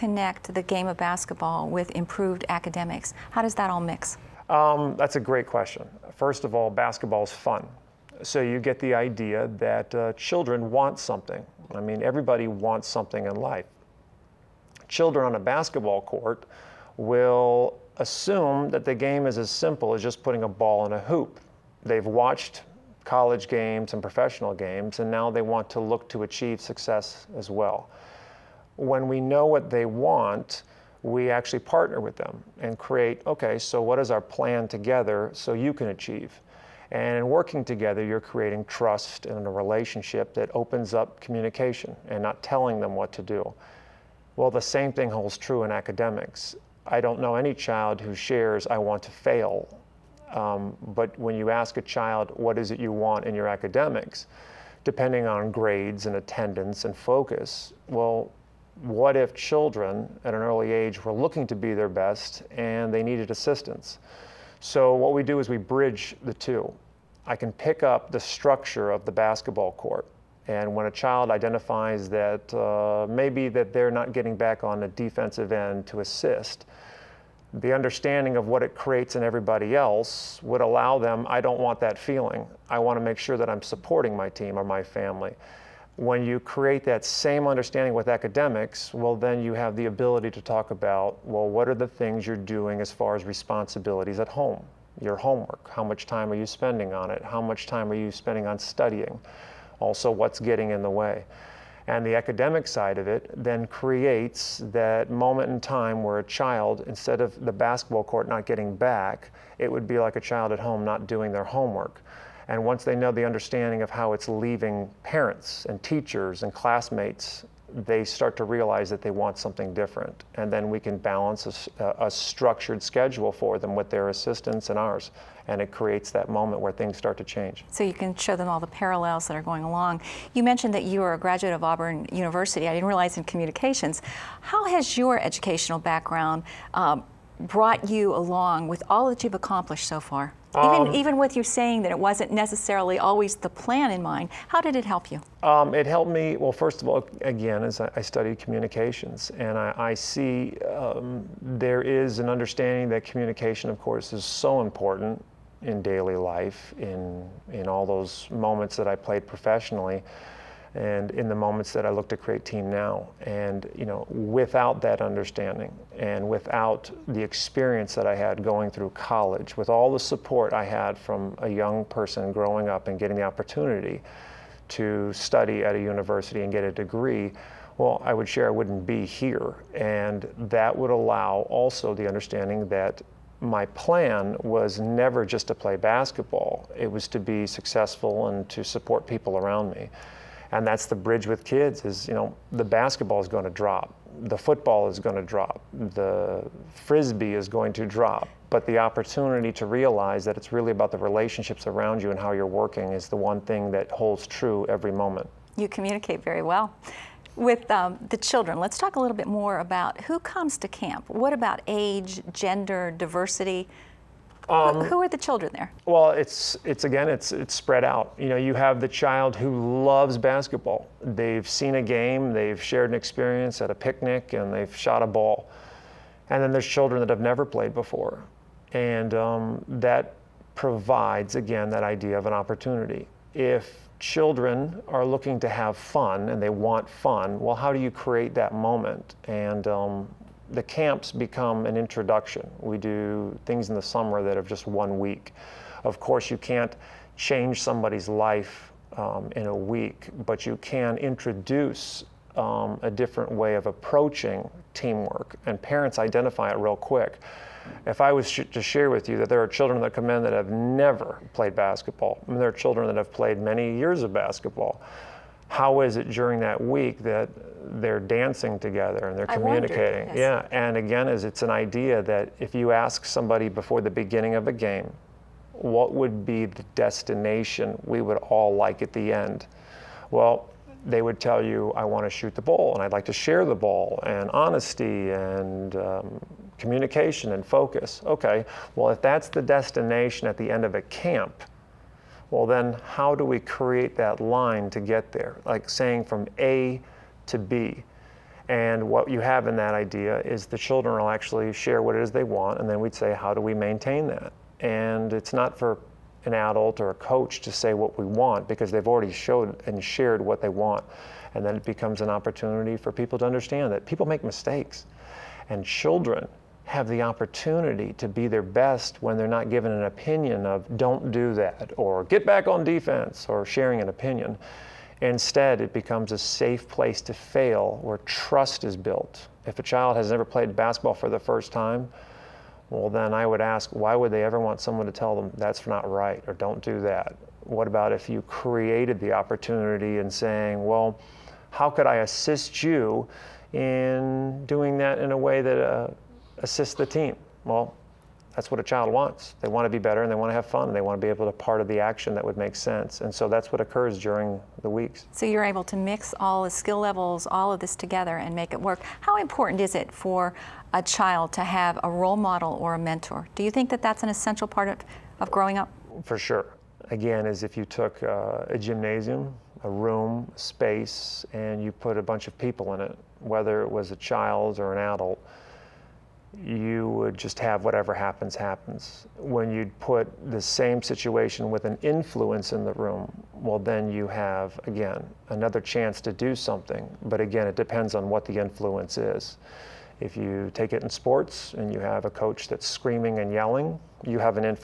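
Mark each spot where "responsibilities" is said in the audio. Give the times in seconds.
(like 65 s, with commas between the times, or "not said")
93 s.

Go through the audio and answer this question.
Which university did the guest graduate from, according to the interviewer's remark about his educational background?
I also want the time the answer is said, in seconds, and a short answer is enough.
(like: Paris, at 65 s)
Auburn University, at 131 s.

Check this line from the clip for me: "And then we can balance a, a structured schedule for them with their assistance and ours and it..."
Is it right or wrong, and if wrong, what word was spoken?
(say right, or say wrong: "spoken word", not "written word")
right.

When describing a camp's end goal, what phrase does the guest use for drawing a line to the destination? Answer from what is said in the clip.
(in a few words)
From A to B.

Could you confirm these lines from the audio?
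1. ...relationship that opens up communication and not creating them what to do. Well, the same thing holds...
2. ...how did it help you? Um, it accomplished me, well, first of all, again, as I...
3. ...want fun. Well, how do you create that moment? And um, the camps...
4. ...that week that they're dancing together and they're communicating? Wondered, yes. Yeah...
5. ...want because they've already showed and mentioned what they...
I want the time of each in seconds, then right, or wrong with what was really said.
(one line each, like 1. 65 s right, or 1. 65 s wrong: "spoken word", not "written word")
1. 39 s wrong: "telling", not "creating"
2. 144 s wrong: "helped", not "accomplished"
3. 236 s right
4. 266 s right
5. 308 s wrong: "shared", not "mentioned".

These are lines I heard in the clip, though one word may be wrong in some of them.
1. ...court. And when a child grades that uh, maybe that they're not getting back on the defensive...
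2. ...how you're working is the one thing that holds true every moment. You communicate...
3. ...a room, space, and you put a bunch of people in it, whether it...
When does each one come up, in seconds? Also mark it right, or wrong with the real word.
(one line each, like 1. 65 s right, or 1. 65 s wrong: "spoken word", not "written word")
1. 69 s wrong: "identifies", not "grades"
2. 202 s right
3. 369 s right.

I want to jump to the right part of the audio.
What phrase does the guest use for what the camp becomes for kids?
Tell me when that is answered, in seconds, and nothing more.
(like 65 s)
326 s.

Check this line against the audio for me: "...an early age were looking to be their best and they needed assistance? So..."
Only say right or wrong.
right.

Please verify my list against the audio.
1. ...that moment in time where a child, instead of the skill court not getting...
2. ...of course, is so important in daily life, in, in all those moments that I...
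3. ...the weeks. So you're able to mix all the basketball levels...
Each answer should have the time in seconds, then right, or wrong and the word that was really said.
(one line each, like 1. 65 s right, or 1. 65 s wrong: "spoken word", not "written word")
1. 104 s wrong: "basketball", not "skill"
2. 153 s right
3. 354 s wrong: "skill", not "basketball".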